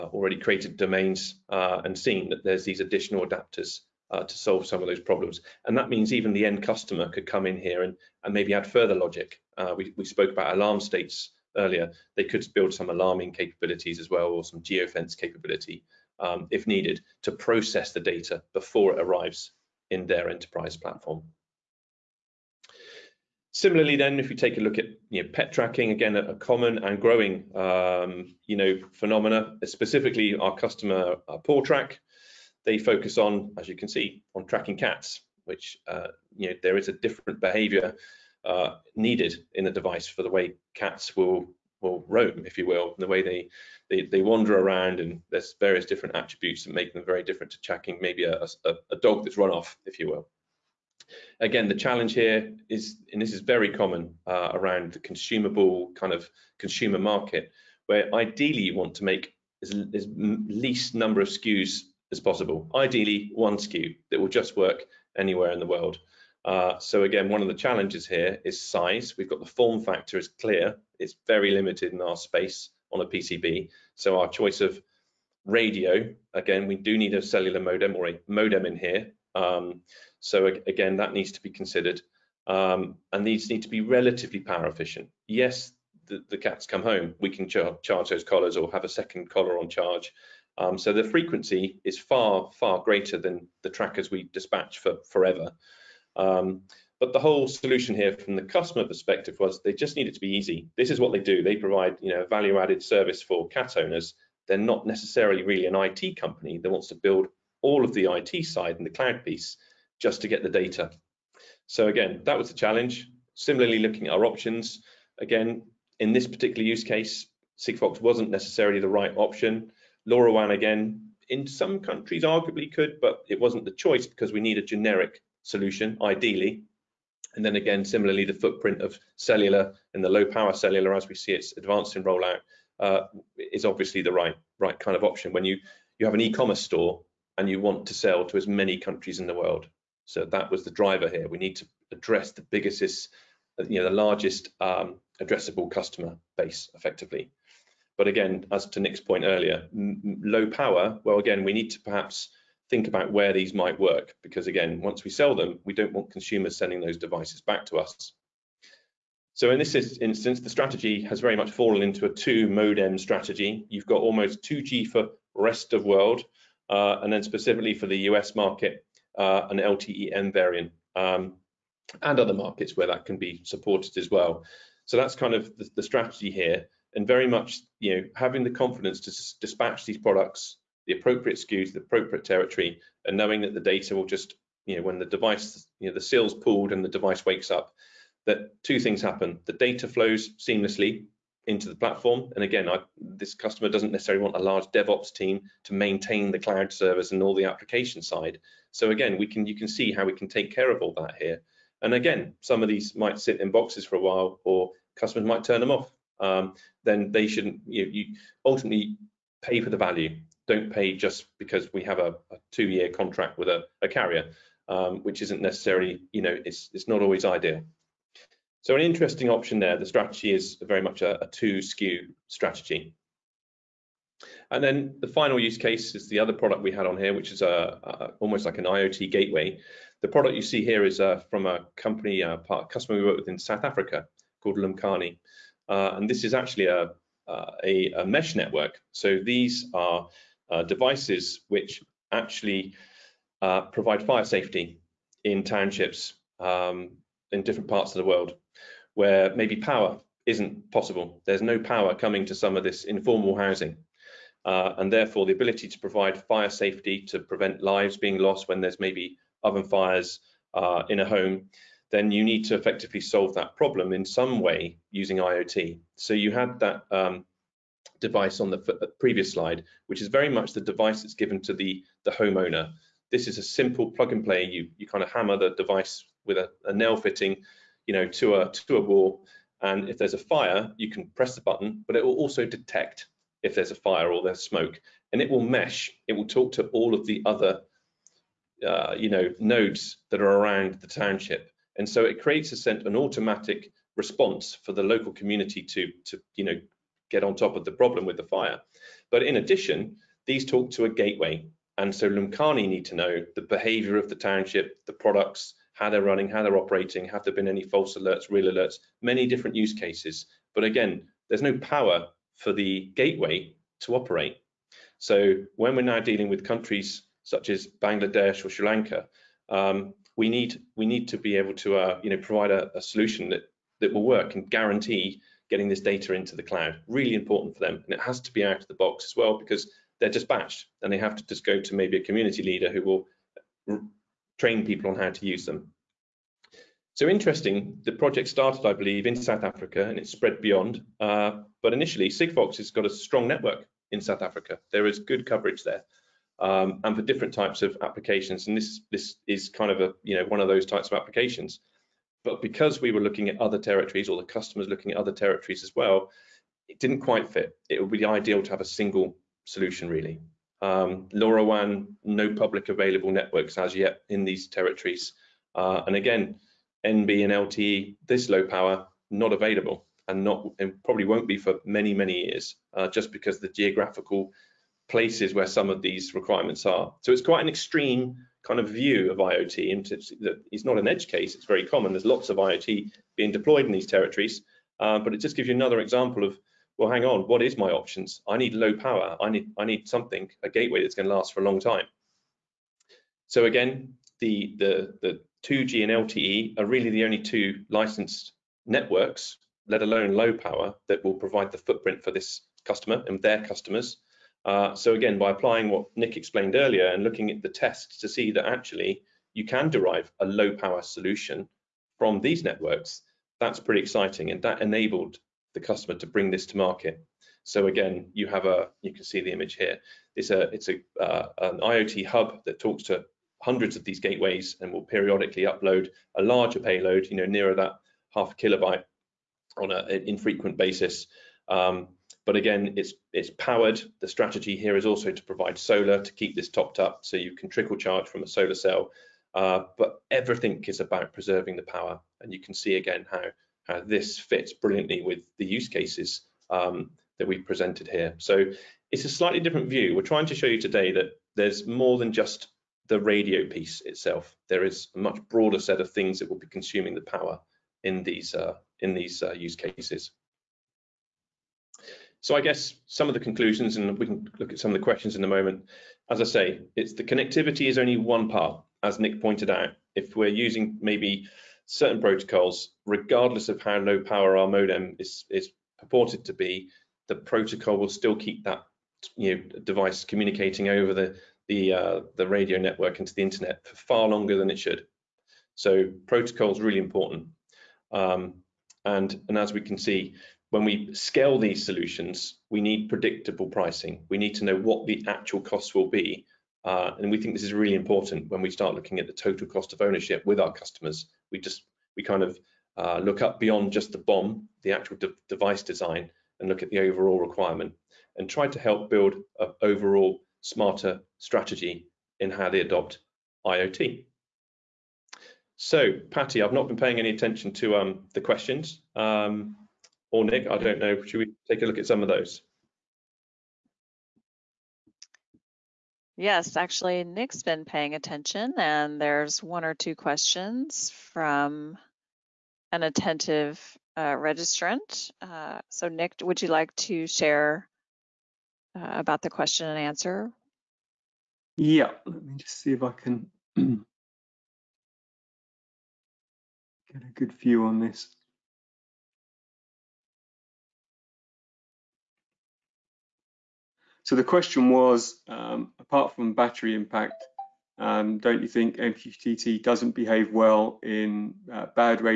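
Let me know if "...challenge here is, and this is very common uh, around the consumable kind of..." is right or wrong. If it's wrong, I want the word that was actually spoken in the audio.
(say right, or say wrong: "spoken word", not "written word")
right.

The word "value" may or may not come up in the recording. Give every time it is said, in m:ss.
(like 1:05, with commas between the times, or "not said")
1:42, 3:29.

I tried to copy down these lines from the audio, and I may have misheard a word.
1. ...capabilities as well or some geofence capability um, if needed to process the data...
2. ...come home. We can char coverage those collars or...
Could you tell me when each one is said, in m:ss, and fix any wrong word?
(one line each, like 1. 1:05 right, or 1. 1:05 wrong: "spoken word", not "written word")
1. 0:13 right
2. 1:26 wrong: "charge", not "coverage".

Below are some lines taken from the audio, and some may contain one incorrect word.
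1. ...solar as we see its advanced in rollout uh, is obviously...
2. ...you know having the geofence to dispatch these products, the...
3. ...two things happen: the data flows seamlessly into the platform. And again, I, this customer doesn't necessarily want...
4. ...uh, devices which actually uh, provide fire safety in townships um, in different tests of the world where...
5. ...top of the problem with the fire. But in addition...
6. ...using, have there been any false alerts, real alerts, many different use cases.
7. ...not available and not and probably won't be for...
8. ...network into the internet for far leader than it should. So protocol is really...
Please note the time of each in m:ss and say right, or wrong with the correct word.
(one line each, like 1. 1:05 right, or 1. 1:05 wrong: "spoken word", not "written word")
1. 2:10 wrong: "cellular", not "solar"
2. 2:57 wrong: "confidence", not "geofence"
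3. 3:08 right
4. 4:00 wrong: "parts", not "tests"
5. 4:57 right
6. 5:06 wrong: "operating", not "using"
7. 6:09 right
8. 8:02 wrong: "longer", not "leader".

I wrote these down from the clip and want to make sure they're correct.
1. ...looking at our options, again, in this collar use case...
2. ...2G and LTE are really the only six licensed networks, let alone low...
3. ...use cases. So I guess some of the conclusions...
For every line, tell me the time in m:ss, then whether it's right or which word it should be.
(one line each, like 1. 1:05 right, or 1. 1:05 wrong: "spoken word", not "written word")
1. 1:53 wrong: "particular", not "collar"
2. 6:35 wrong: "two", not "six"
3. 7:39 right.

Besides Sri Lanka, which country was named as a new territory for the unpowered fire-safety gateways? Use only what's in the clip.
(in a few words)
Bangladesh.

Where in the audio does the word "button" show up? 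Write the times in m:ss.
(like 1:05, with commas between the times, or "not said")
4:41.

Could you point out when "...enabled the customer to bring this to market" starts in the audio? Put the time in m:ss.
6:54.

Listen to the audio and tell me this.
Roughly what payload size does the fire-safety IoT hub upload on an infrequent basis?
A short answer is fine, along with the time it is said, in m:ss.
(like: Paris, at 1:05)
half a kilobyte, at 7:08.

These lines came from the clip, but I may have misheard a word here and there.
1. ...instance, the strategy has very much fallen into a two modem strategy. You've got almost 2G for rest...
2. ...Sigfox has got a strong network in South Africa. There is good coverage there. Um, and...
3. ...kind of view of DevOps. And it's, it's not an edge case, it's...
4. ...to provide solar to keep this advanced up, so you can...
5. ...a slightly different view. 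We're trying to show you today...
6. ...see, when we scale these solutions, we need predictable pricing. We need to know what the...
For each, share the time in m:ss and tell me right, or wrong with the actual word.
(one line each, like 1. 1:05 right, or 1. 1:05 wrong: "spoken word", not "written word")
1. 2:39 right
2. 5:42 right
3. 6:18 wrong: "IoT", not "DevOps"
4. 7:15 wrong: "topped", not "advanced"
5. 7:29 right
6. 8:09 right.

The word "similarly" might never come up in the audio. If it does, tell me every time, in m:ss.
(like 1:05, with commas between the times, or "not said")
0:23, 1:53, 2:07.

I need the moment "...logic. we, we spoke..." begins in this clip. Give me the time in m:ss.
0:08.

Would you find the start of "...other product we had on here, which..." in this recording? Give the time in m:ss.
3:46.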